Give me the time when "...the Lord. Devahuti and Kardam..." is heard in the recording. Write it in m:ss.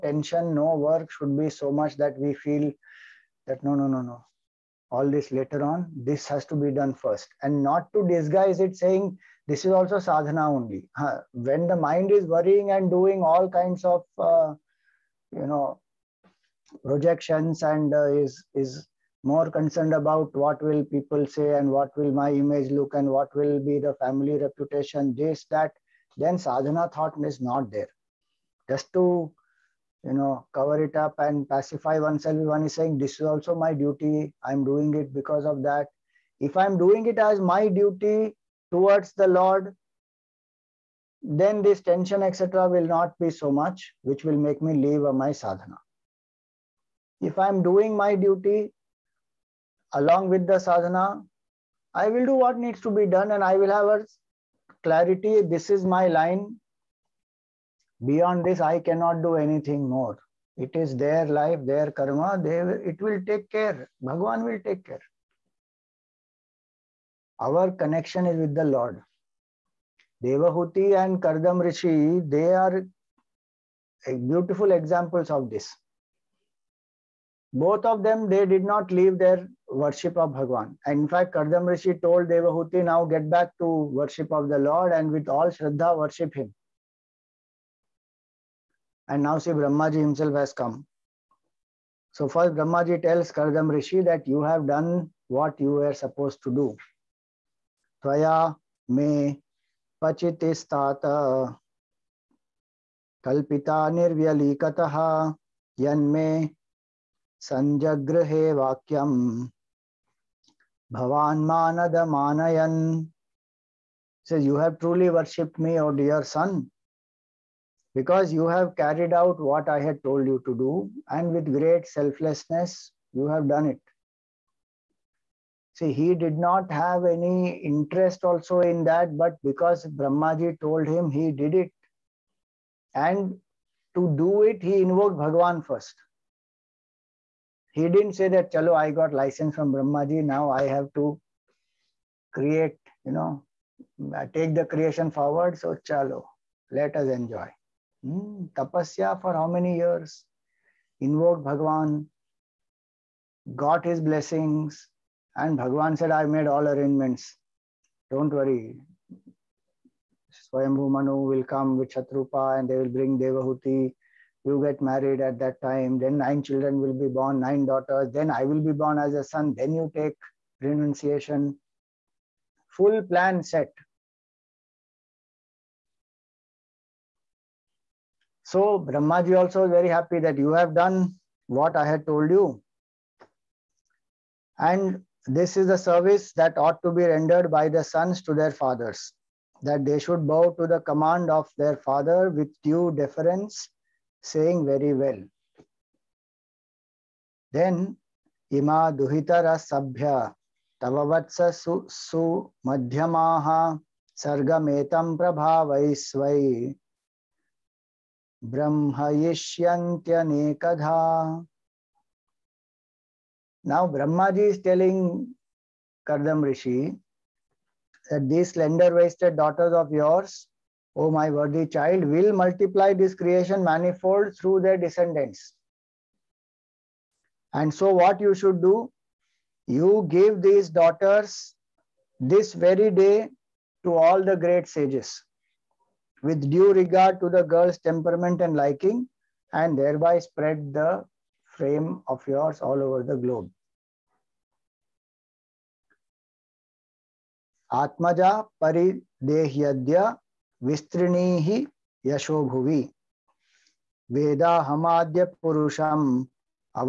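1:08.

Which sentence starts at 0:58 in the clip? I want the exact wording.
Beyond this, I cannot do anything more.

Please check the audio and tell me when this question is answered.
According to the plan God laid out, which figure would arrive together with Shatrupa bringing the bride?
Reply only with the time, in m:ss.
2:40.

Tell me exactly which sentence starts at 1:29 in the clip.
And now see Brahmaji himself has come.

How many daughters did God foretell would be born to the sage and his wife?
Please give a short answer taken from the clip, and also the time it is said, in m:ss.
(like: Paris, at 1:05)
9, at 2:47.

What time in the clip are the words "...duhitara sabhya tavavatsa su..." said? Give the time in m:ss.
3:19.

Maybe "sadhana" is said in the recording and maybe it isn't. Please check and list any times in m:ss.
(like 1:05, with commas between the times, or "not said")
0:09, 0:26, 0:45, 0:50.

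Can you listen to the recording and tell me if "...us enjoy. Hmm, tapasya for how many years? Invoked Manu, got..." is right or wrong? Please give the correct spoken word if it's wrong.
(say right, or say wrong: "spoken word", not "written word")
wrong: "Bhagwan", not "Manu".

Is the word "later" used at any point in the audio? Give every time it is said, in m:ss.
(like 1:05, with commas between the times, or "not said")
0:05.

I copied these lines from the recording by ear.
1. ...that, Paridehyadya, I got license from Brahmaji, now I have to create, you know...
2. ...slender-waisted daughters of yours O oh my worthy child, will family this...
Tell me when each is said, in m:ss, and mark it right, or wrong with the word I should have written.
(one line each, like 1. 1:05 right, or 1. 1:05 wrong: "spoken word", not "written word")
1. 2:18 wrong: "Chalo", not "Paridehyadya"
2. 3:38 wrong: "multiply", not "family".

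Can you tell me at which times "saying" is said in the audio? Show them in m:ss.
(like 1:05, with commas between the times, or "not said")
0:08, 0:32, 3:14.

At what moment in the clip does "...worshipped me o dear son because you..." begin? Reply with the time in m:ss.
1:55.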